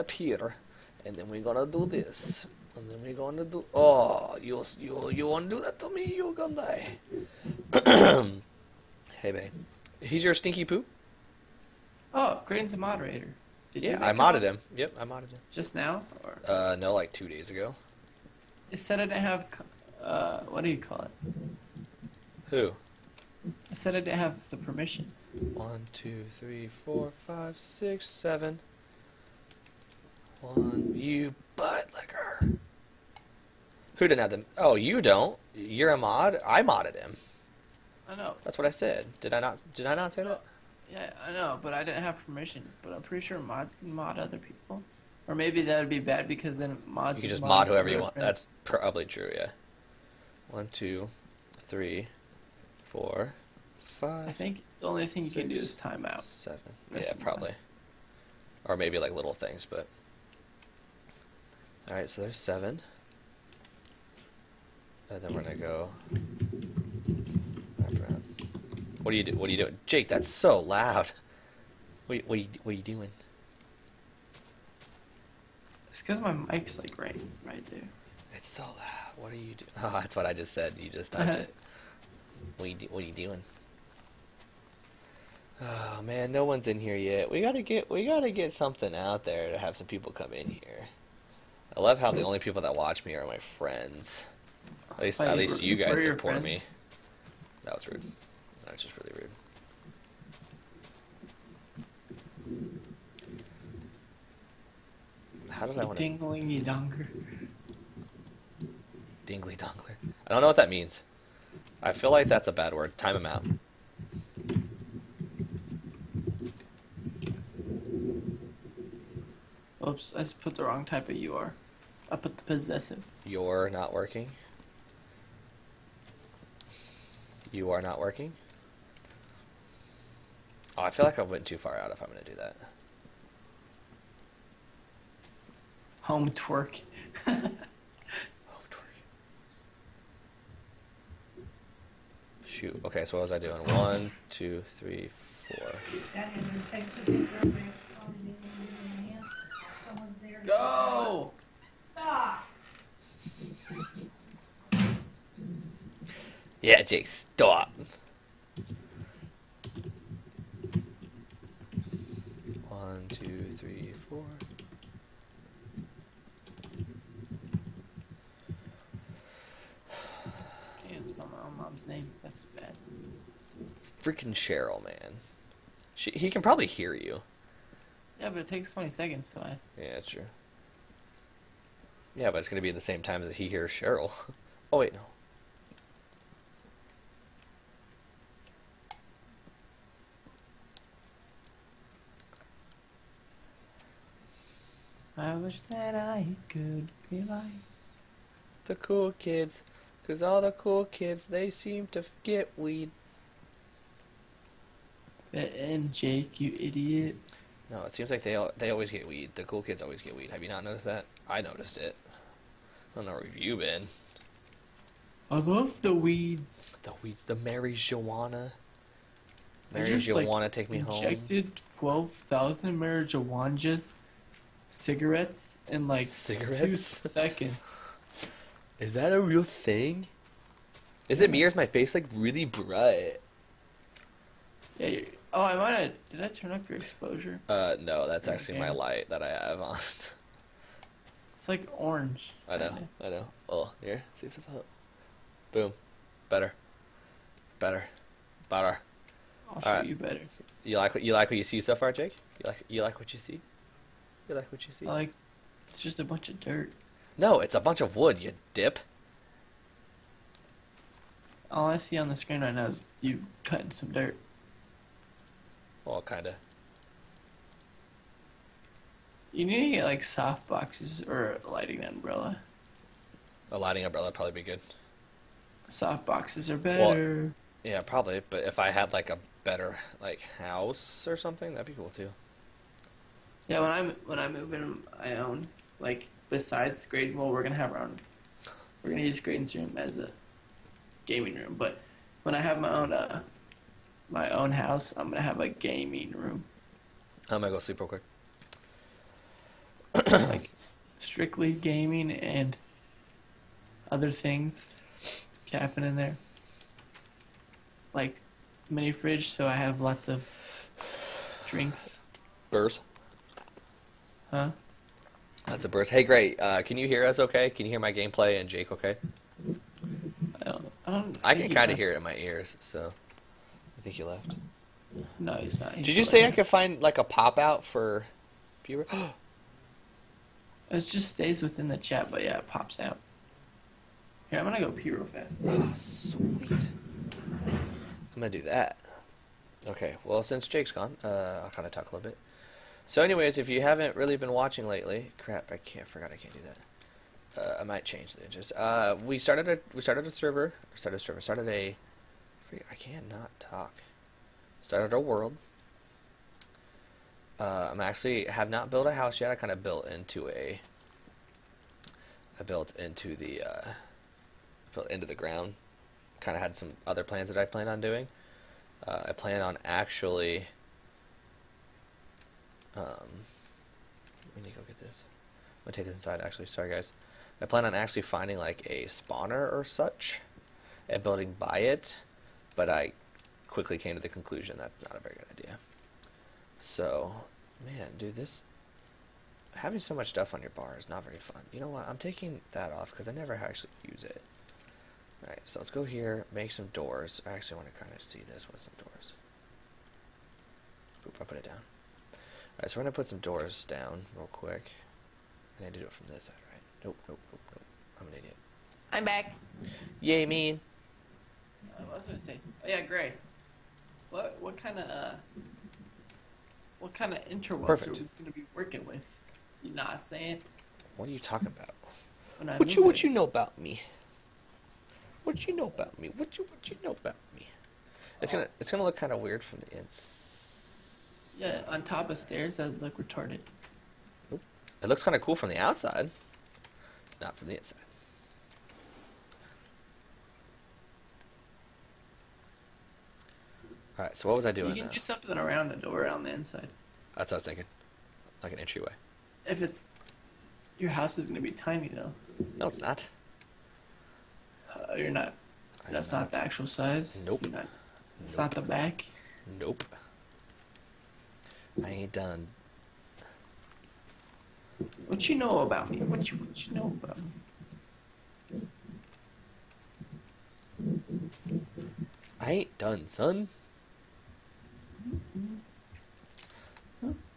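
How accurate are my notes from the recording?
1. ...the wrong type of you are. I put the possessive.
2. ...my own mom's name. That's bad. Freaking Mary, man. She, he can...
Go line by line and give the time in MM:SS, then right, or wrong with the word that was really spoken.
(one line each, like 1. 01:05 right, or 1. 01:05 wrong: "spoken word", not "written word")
1. 02:00 right
2. 02:51 wrong: "Cheryl", not "Mary".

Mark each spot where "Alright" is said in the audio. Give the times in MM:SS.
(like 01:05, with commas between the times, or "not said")
06:35, 06:42.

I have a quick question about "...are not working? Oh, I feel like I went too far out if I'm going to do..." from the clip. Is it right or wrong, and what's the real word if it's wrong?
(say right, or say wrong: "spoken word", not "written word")
right.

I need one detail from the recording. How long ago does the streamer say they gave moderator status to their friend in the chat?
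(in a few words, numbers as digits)
2 days ago.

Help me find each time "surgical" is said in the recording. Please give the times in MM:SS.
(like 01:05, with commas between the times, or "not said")
not said.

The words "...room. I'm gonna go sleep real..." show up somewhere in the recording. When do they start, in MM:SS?
04:56.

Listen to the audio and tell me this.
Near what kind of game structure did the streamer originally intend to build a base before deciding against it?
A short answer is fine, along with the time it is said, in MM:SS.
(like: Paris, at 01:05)
A spawner, at 06:18.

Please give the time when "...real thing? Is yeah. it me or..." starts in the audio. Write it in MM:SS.
03:49.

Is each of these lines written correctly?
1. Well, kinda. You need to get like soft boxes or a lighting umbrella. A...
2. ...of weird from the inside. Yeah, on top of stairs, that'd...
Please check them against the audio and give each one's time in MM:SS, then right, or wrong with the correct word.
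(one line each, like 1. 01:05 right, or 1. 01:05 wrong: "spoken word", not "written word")
1. 04:25 right
2. 07:09 right.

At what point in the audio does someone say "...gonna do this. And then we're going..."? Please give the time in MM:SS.
00:01.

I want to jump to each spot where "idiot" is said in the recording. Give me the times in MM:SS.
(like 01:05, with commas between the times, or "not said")
03:26, 06:48.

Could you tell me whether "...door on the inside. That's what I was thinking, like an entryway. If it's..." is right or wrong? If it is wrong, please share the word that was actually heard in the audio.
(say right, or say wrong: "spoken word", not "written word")
right.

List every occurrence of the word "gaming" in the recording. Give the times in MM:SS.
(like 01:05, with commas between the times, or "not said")
04:51, 04:55, 05:01.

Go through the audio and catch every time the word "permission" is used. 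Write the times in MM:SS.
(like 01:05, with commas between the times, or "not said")
00:24, 00:42.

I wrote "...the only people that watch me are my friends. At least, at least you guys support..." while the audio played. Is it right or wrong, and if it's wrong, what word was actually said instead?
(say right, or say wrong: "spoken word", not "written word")
right.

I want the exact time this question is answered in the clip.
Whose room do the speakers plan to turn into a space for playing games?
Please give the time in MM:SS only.
04:49.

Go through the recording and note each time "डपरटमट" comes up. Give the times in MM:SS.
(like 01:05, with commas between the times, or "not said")
not said.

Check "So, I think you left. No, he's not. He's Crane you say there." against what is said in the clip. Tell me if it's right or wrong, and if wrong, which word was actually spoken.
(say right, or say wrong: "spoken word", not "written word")
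wrong: "Did", not "Crane".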